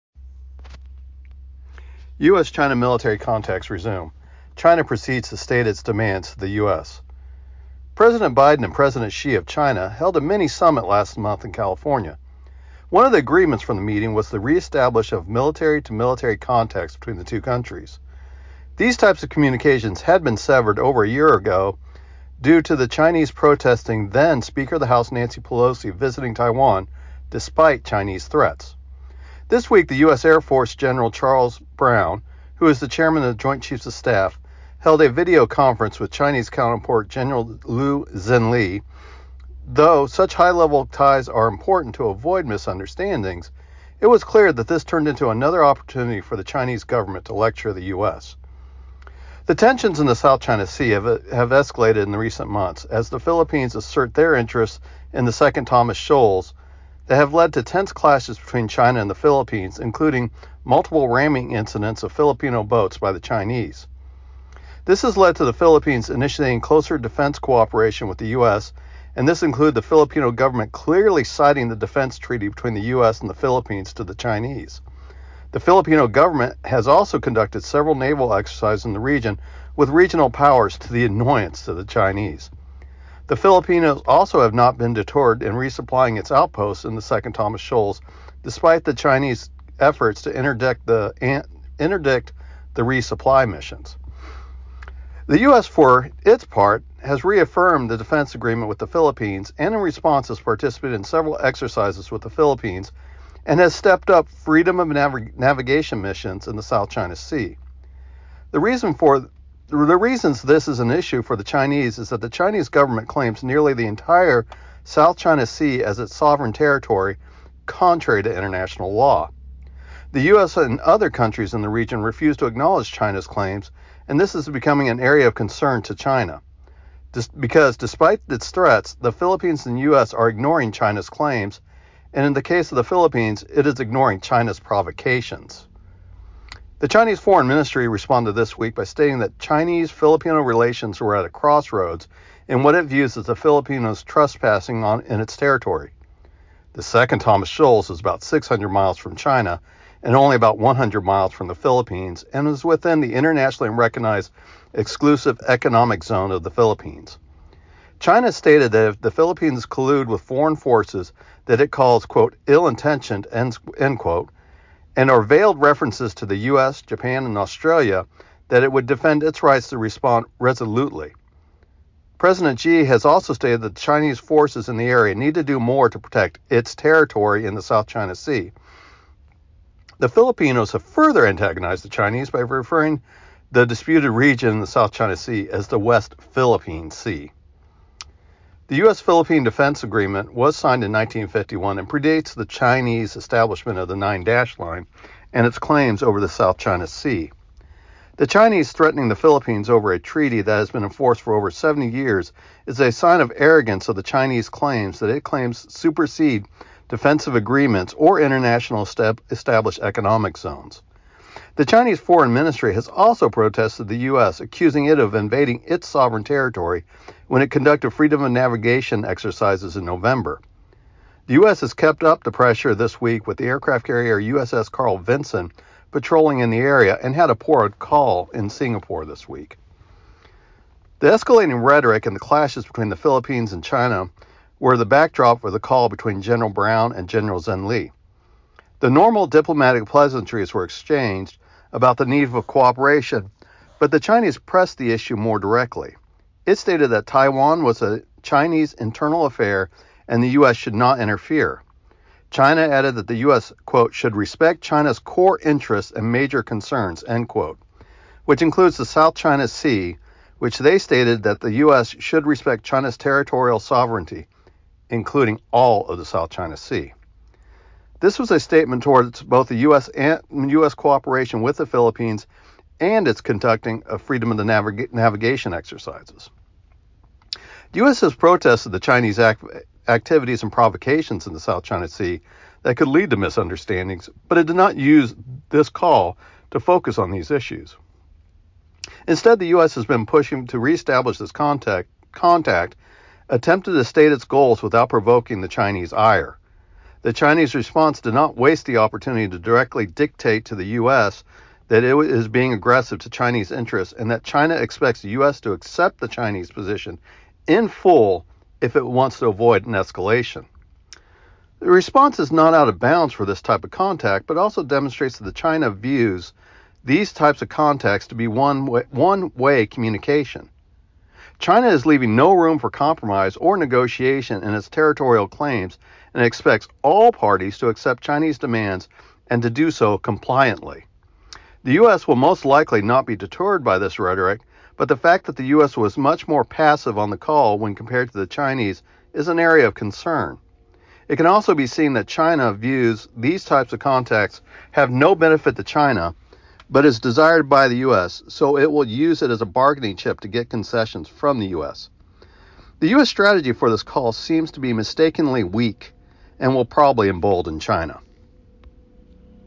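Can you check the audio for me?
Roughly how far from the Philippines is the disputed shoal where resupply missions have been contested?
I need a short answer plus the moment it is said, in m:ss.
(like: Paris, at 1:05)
100 miles, at 2:30.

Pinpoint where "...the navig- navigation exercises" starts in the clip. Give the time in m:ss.
4:34.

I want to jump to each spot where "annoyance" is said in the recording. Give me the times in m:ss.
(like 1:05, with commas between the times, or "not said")
1:21.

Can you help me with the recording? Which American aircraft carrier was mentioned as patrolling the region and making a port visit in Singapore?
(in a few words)
USS Carl Vinson.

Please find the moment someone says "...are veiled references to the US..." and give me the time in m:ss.
2:45.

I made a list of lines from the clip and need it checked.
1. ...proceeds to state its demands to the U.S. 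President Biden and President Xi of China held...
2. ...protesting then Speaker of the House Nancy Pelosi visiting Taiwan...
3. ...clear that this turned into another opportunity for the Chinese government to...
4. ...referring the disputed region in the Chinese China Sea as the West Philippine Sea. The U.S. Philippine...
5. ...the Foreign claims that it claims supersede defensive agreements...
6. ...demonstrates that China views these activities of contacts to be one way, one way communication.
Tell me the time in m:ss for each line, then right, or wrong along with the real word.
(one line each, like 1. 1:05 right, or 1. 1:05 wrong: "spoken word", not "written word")
1. 0:04 right
2. 0:23 right
3. 0:44 right
4. 3:02 wrong: "South", not "Chinese"
5. 3:23 wrong: "Chinese", not "Foreign"
6. 5:14 wrong: "types", not "activities".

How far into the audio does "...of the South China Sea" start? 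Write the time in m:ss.
4:25.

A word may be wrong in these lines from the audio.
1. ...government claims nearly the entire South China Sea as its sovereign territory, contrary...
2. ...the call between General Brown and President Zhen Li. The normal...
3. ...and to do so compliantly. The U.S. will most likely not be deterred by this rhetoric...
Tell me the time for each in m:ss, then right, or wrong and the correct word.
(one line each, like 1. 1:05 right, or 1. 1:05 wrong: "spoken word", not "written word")
1. 1:52 right
2. 3:55 wrong: "General", not "President"
3. 5:29 right.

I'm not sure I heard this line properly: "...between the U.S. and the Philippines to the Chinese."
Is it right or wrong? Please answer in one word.
right.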